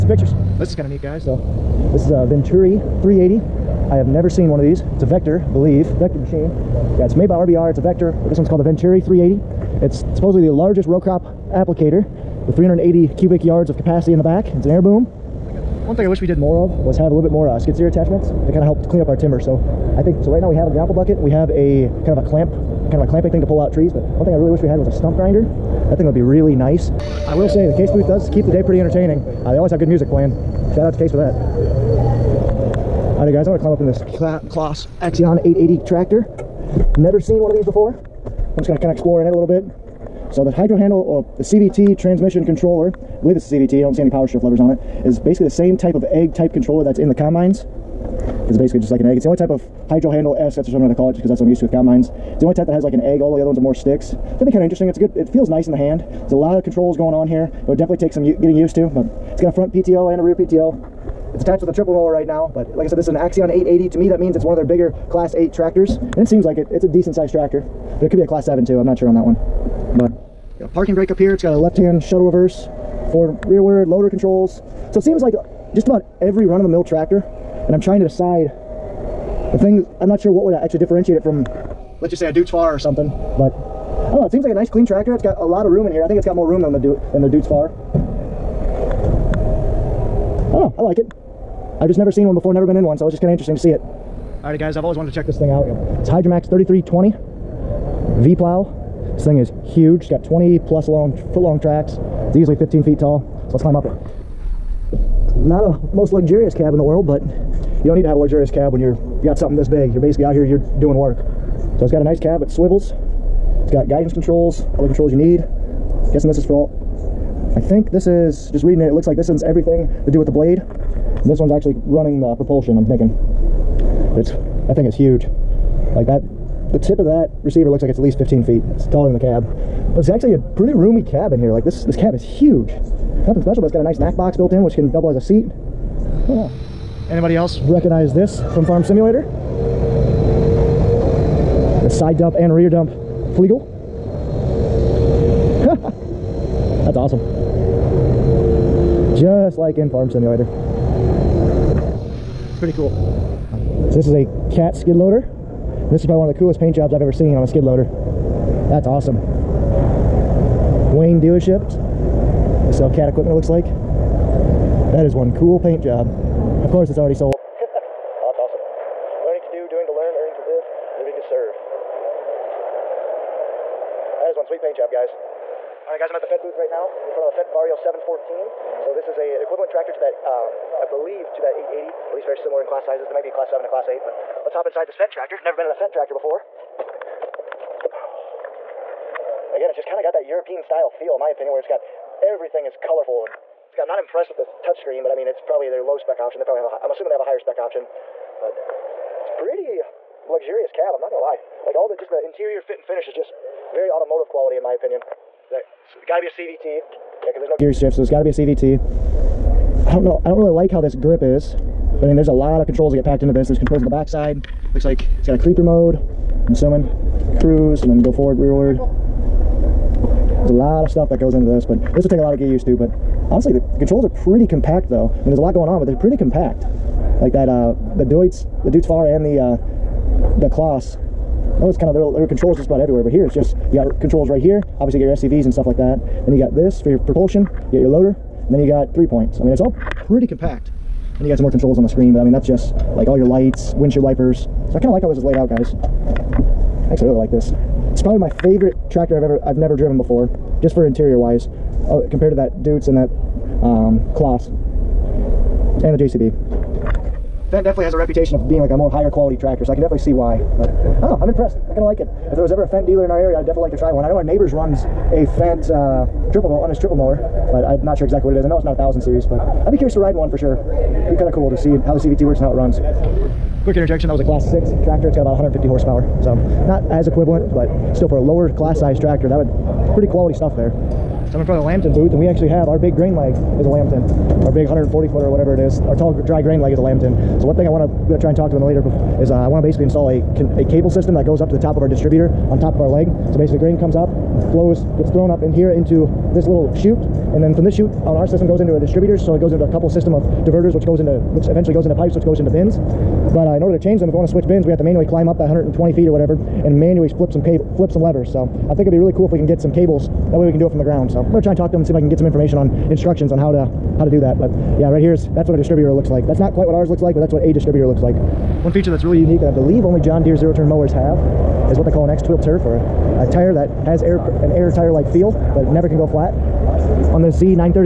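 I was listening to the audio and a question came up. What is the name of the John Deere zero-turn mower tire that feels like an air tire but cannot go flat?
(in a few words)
X-Tweel.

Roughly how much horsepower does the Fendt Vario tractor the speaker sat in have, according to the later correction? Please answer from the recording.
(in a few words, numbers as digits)
150.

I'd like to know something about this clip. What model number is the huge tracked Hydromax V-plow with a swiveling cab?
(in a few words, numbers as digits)
3320.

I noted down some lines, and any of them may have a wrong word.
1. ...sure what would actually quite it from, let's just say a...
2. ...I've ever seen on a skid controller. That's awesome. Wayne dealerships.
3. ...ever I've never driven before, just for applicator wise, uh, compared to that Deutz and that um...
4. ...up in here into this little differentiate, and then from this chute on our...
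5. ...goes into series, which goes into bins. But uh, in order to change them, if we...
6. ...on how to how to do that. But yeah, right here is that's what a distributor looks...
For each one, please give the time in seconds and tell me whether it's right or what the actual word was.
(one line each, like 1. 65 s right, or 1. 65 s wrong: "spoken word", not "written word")
1. 80 s wrong: "differentiate", not "quite"
2. 156 s wrong: "loader", not "controller"
3. 249 s wrong: "interior", not "applicator"
4. 295 s wrong: "chute", not "differentiate"
5. 301 s wrong: "pipes", not "series"
6. 313 s right.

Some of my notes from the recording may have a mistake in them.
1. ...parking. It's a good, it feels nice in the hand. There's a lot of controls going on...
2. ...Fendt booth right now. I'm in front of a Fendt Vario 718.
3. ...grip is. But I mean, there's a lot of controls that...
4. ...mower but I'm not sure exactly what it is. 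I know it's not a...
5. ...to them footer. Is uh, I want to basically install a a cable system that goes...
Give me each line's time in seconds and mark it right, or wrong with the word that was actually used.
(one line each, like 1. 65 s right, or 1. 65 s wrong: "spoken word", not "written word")
1. 54 s wrong: "interesting", not "parking"
2. 176 s wrong: "714", not "718"
3. 210 s right
4. 266 s right
5. 288 s wrong: "later", not "footer".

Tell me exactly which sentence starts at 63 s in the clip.
To me, that means it's one of their bigger Class 8 tractors, and it seems like it.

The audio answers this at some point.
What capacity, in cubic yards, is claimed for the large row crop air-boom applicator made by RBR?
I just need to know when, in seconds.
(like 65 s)
12 s.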